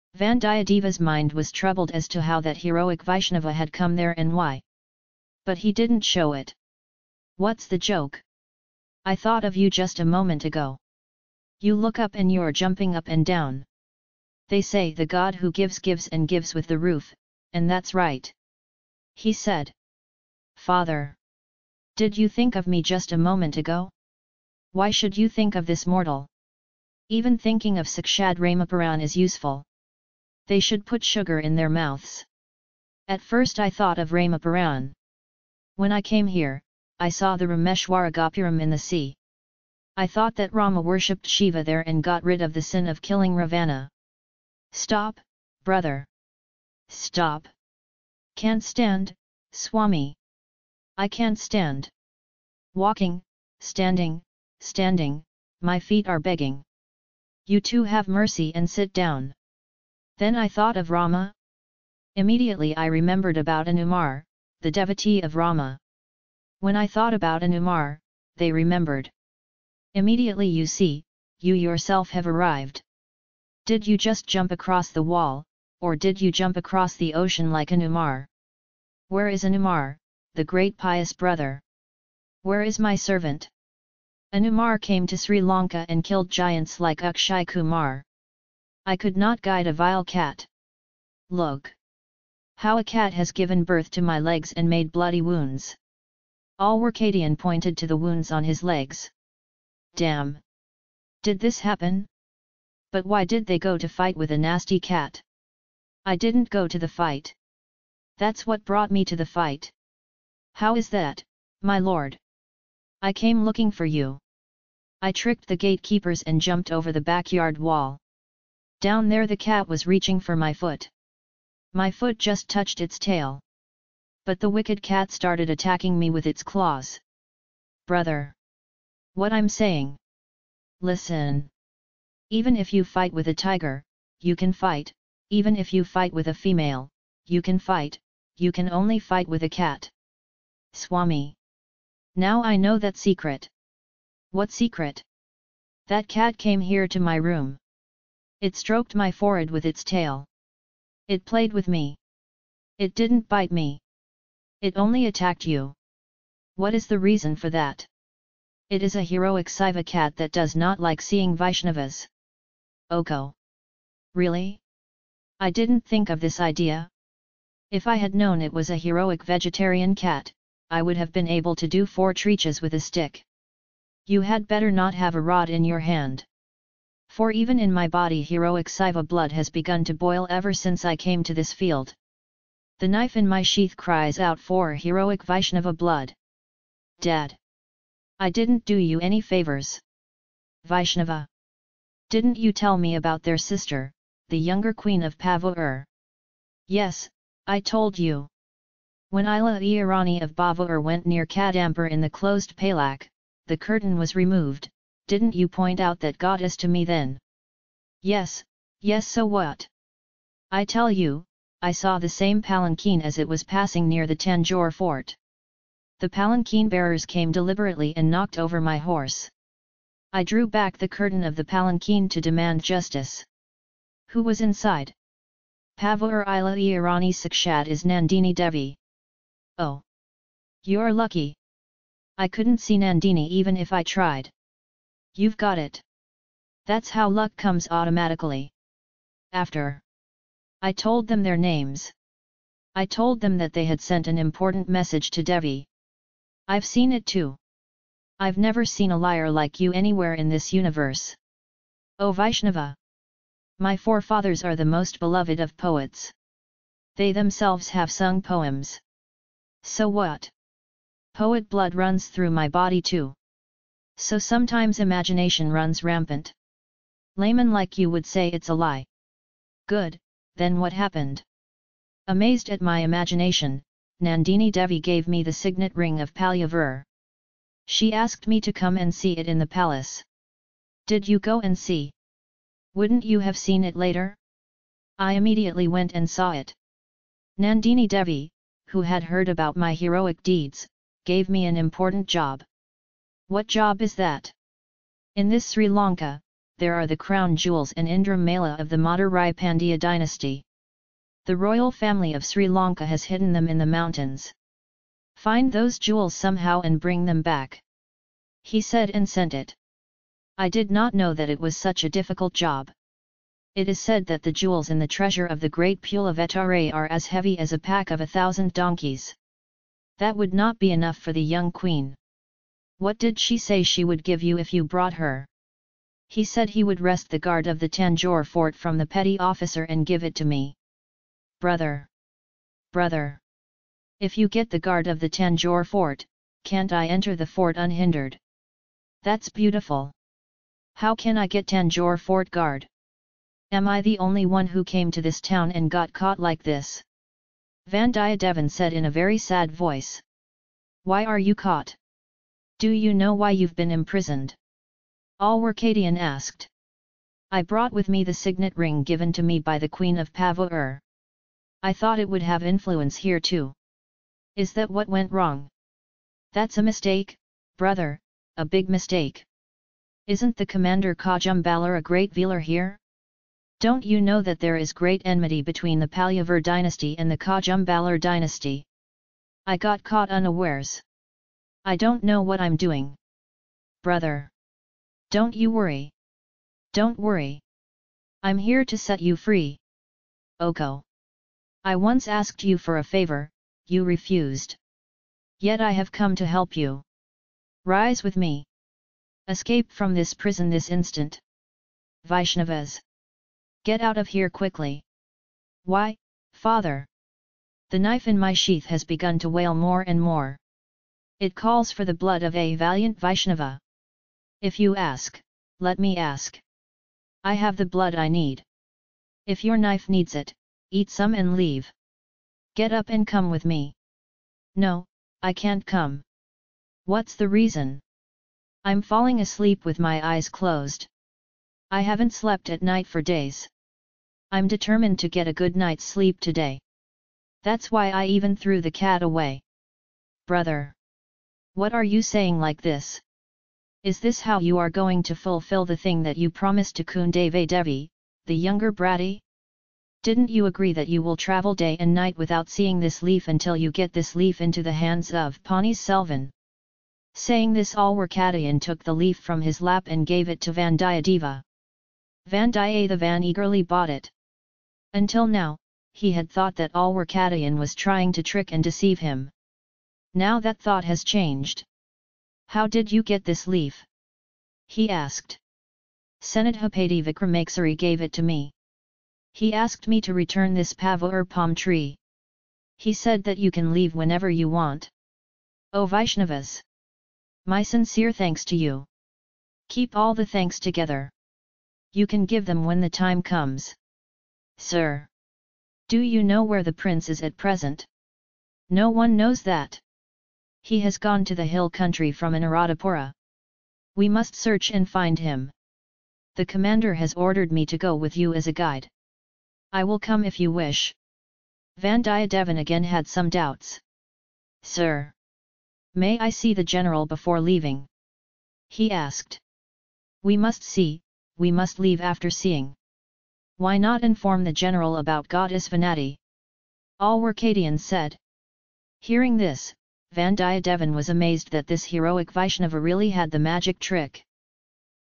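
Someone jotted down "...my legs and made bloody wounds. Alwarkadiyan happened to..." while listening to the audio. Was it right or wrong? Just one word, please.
wrong.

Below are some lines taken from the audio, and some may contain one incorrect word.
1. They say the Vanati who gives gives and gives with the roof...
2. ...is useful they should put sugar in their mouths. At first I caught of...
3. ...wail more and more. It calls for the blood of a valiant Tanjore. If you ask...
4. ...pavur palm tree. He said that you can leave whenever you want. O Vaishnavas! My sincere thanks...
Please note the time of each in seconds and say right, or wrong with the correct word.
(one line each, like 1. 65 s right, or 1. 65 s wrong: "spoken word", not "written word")
1. 14 s wrong: "God", not "Vanati"
2. 29 s wrong: "thought", not "caught"
3. 409 s wrong: "Vaishnava", not "Tanjore"
4. 480 s right.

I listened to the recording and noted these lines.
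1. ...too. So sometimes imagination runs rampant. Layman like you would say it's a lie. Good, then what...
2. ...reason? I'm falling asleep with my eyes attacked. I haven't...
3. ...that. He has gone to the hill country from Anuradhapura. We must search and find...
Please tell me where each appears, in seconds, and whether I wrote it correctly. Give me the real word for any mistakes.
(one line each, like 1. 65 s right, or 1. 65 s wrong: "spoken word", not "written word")
1. 262 s right
2. 427 s wrong: "closed", not "attacked"
3. 499 s right.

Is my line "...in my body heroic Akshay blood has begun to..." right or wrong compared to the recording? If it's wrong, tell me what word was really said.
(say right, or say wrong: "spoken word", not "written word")
wrong: "Siva", not "Akshay".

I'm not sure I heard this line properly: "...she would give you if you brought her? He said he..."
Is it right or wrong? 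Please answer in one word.
right.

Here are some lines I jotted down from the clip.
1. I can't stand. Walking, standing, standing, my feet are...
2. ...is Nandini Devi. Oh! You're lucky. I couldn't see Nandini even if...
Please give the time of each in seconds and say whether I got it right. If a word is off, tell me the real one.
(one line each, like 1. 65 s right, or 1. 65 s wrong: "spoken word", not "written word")
1. 50 s right
2. 227 s right.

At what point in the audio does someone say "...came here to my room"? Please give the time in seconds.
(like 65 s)
146 s.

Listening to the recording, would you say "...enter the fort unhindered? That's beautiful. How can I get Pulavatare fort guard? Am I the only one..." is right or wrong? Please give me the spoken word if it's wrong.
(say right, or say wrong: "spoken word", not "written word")
wrong: "Tanjore", not "Pulavatare".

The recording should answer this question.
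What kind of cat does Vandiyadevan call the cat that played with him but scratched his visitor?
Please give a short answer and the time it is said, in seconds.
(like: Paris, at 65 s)
heroic Saiva cat, at 159 s.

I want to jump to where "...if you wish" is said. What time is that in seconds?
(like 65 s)
510 s.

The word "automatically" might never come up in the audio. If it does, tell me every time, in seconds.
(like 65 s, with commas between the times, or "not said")
237 s.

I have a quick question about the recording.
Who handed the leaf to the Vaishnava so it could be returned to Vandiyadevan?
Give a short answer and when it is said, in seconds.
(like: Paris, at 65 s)
Vikramakesari, at 477 s.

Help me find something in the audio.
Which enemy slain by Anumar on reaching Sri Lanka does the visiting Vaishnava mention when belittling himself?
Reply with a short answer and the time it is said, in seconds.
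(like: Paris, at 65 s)
Akshay Kumar, at 87 s.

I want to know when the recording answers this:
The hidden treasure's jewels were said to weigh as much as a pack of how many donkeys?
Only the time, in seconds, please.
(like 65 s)
318 s.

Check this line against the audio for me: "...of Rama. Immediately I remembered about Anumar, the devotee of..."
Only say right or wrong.
right.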